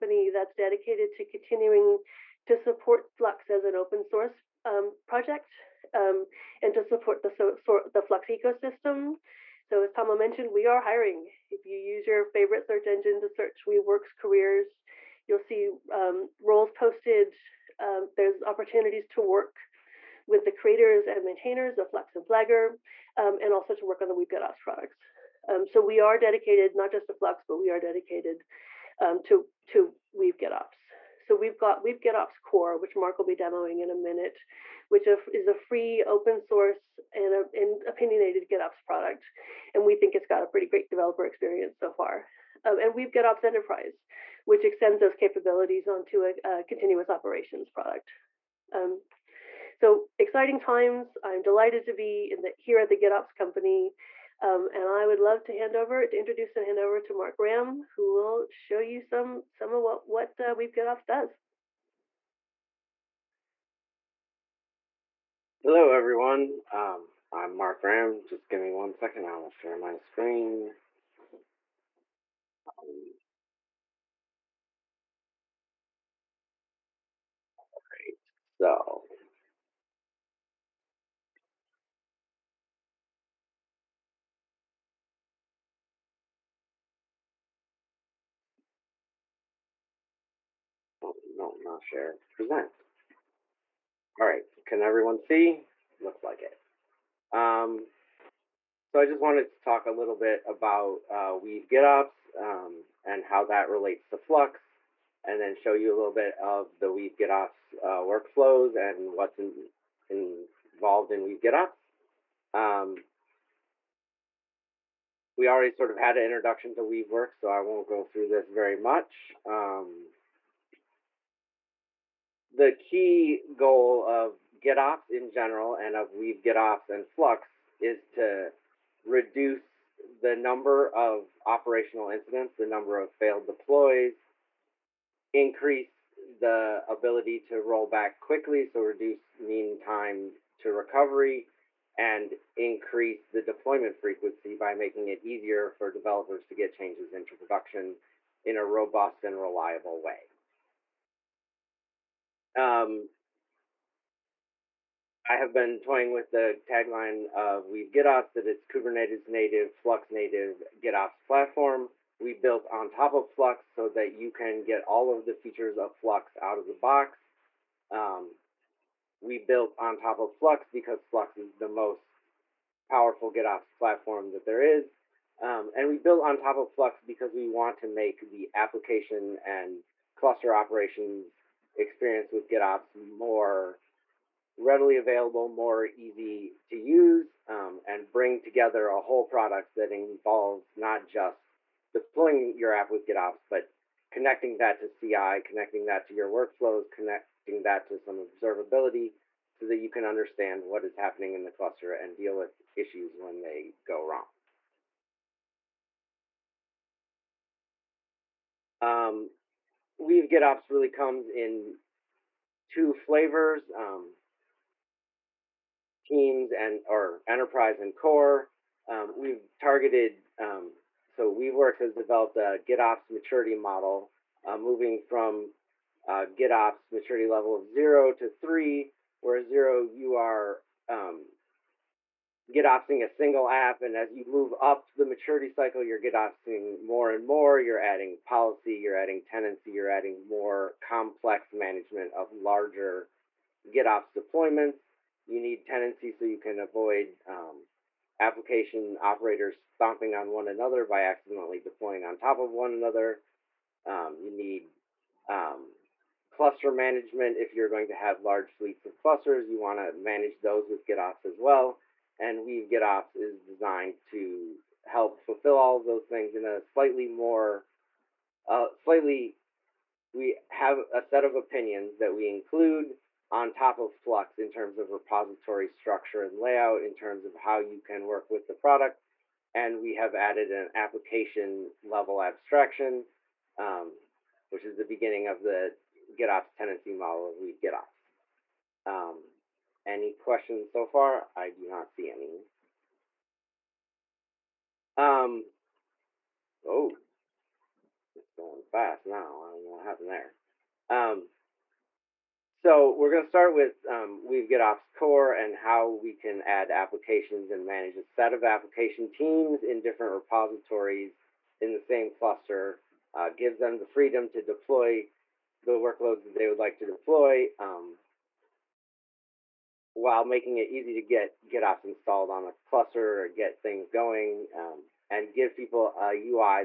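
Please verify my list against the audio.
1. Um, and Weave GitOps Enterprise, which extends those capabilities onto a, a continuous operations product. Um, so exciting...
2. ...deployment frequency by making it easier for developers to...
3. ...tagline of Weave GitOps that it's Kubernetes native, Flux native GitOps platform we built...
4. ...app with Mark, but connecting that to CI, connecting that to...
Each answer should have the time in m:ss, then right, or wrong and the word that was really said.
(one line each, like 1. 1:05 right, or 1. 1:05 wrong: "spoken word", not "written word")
1. 0:42 right
2. 2:23 right
3. 2:36 right
4. 3:12 wrong: "GitOps", not "Mark".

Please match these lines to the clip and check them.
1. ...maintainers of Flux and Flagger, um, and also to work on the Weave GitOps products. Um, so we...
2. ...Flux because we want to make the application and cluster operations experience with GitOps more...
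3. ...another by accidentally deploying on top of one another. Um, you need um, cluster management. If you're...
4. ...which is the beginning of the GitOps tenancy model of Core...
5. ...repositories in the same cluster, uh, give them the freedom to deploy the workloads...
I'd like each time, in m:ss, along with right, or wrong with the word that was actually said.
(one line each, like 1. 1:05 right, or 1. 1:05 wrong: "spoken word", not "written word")
1. 0:21 right
2. 2:56 right
3. 4:10 right
4. 4:44 wrong: "Weave", not "Core"
5. 5:10 right.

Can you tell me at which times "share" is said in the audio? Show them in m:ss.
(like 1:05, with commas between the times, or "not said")
1:09, 1:31.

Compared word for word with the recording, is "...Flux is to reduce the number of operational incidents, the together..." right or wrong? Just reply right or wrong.
wrong.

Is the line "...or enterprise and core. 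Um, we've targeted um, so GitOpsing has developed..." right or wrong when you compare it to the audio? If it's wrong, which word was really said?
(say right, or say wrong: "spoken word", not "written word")
wrong: "WeaveWorks", not "GitOpsing".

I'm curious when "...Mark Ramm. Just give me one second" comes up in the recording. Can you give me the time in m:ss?
1:07.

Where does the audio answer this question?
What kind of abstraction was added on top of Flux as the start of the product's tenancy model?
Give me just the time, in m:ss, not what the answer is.
4:40.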